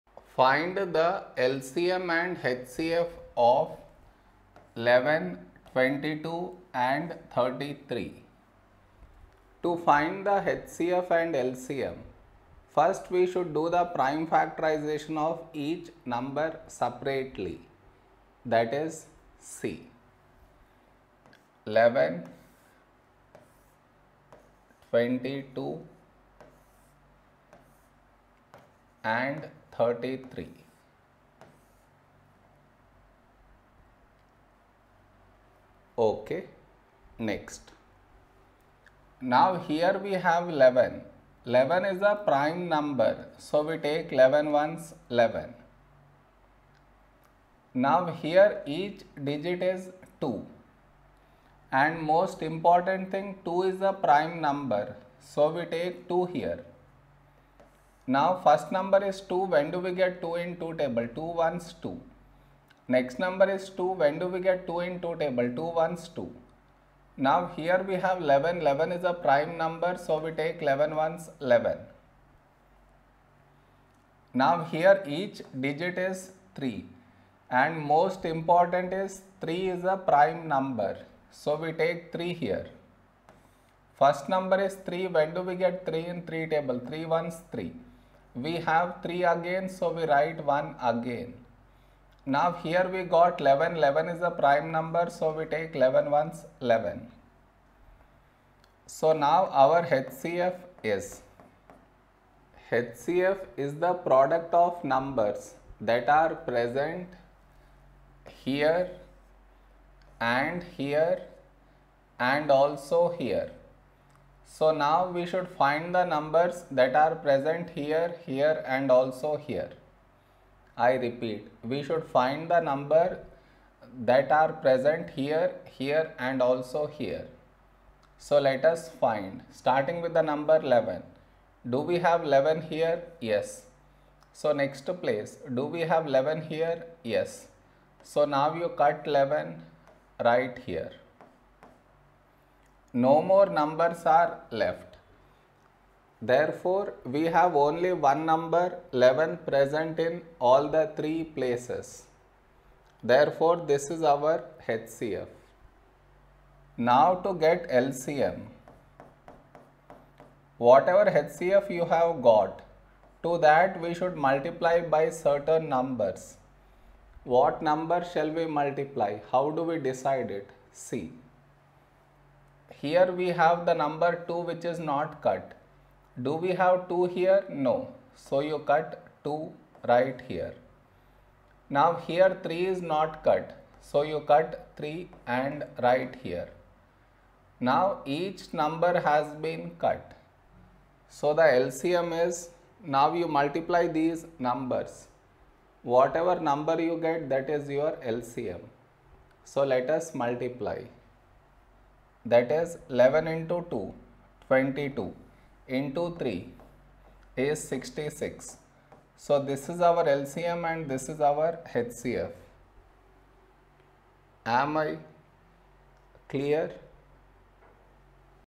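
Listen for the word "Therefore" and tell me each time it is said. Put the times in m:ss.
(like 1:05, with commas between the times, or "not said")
2:26, 2:33.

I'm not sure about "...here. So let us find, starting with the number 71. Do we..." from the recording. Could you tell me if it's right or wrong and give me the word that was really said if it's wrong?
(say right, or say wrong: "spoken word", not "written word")
wrong: "11", not "71".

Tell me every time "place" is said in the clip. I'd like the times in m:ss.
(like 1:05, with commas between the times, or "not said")
2:15, 2:31.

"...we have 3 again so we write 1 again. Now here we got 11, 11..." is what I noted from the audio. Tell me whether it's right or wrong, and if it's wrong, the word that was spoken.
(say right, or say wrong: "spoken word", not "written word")
right.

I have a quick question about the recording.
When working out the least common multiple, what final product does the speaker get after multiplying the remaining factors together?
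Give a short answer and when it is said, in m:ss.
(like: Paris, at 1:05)
66, at 3:24.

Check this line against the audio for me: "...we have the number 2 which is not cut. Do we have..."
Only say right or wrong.
right.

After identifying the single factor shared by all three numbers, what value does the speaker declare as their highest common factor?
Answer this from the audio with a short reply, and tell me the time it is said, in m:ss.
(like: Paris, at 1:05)
11, at 2:33.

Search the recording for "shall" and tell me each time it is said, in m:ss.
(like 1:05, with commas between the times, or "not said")
2:48.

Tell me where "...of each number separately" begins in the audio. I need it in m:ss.
0:15.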